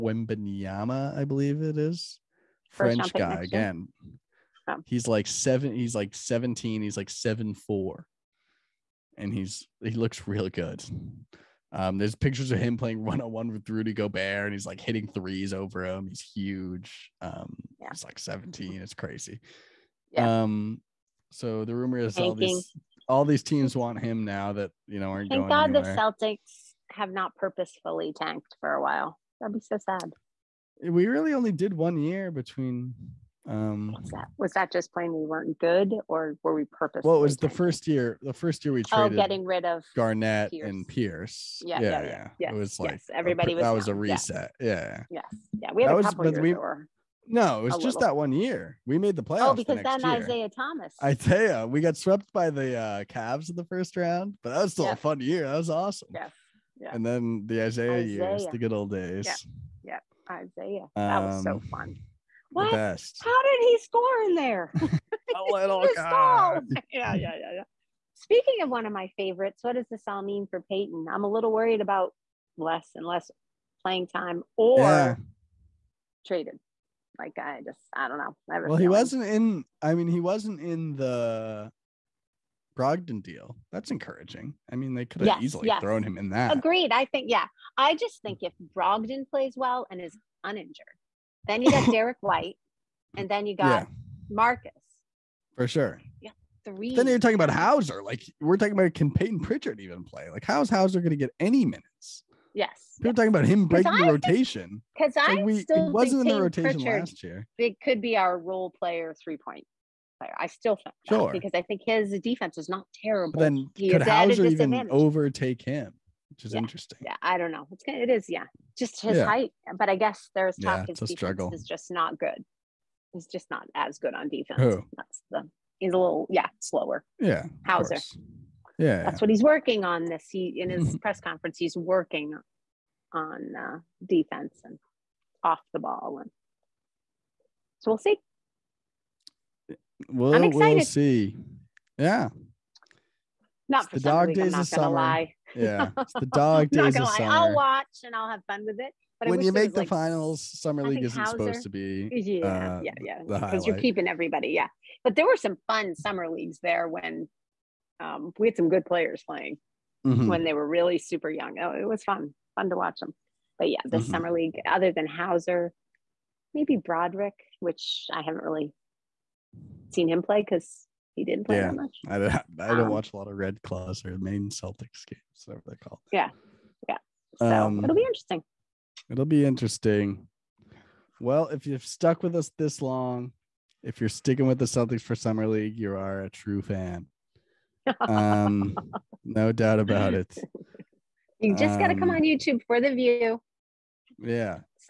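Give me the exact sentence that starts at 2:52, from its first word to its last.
I don't, I don't um, watch a lot of Red Claws or Maine Celtics games, whatever they call.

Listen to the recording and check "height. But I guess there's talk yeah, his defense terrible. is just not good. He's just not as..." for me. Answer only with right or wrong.
wrong.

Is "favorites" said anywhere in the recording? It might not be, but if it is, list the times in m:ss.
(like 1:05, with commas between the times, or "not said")
1:09.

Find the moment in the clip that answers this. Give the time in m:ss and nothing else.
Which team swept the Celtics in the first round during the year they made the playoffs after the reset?
0:53.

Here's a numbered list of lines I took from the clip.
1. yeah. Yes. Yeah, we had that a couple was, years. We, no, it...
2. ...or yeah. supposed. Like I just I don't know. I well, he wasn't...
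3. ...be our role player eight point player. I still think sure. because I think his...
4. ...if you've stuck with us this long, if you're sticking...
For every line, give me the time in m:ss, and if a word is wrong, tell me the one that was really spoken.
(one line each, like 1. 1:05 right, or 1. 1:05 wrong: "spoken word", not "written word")
1. 0:44 right
2. 1:14 wrong: "traded", not "supposed"
3. 1:48 wrong: "three", not "eight"
4. 3:01 right.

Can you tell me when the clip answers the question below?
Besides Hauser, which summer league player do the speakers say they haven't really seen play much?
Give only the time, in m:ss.
2:46.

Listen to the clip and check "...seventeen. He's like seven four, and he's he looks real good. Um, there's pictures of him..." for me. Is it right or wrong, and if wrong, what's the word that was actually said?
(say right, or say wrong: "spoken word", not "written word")
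right.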